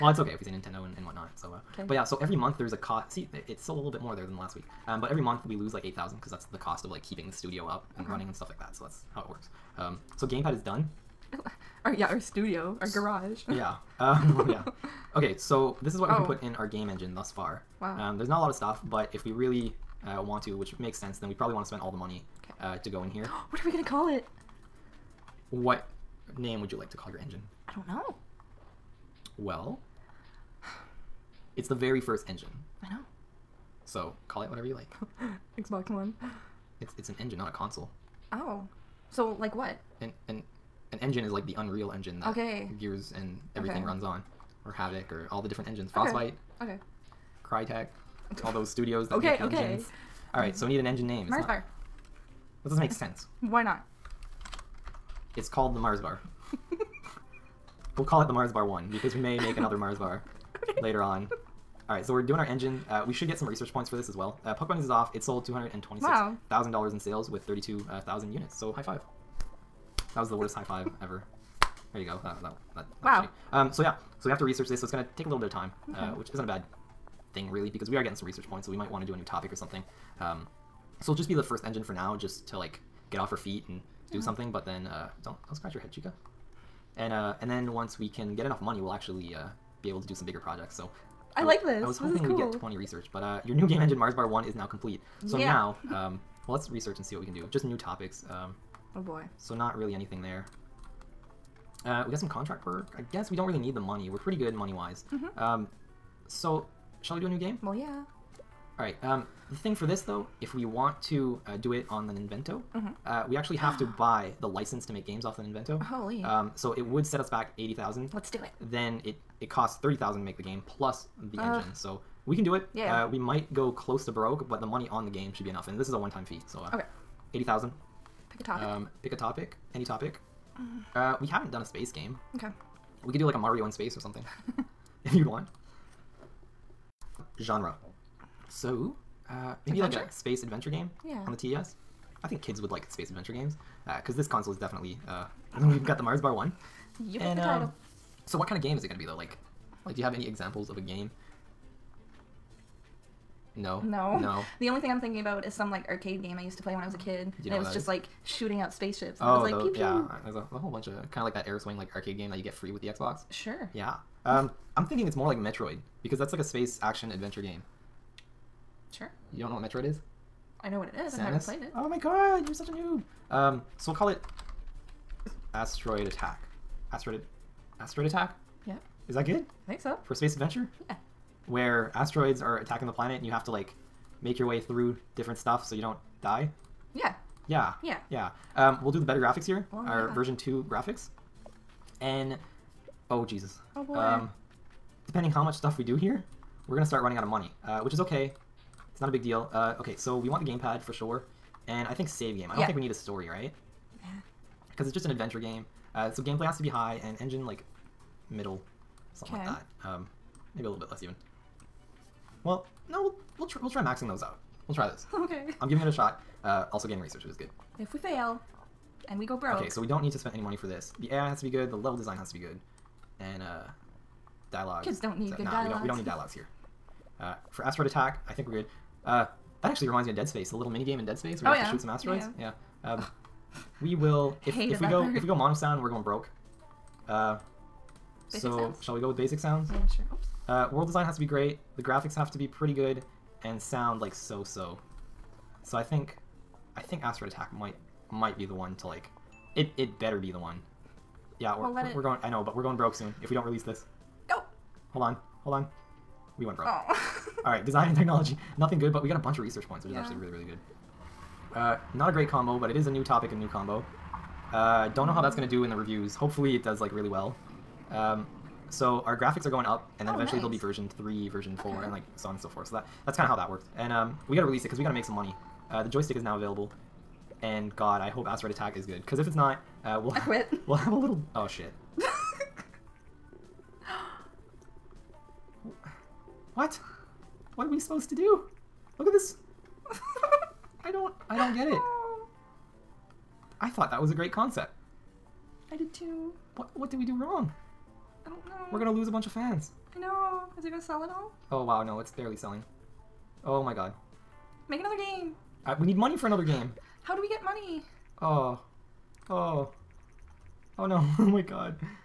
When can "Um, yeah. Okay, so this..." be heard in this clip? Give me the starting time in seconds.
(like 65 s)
13 s.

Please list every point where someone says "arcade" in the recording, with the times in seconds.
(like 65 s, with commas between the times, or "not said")
155 s, 161 s.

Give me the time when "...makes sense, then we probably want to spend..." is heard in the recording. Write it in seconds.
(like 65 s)
20 s.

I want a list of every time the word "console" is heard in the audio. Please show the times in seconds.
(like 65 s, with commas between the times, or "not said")
37 s, 144 s.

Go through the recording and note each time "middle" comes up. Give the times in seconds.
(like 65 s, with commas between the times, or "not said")
208 s.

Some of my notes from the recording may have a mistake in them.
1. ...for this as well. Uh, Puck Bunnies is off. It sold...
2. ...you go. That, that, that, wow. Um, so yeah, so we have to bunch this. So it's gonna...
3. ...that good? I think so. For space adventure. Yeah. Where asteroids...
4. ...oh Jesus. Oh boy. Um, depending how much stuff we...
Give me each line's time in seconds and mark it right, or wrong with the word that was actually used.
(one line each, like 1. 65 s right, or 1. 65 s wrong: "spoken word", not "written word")
1. 63 s right
2. 71 s wrong: "research", not "bunch"
3. 179 s right
4. 193 s right.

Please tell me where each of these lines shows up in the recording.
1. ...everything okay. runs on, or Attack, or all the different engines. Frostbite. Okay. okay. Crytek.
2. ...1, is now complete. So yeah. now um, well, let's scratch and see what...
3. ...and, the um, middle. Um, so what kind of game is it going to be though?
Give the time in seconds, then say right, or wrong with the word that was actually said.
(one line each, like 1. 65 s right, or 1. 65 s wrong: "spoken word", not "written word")
1. 43 s wrong: "Havok", not "Attack"
2. 94 s wrong: "research", not "scratch"
3. 147 s wrong: "title", not "middle".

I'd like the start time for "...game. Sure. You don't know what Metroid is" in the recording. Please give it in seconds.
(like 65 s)
167 s.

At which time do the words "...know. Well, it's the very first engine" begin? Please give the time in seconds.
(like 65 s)
27 s.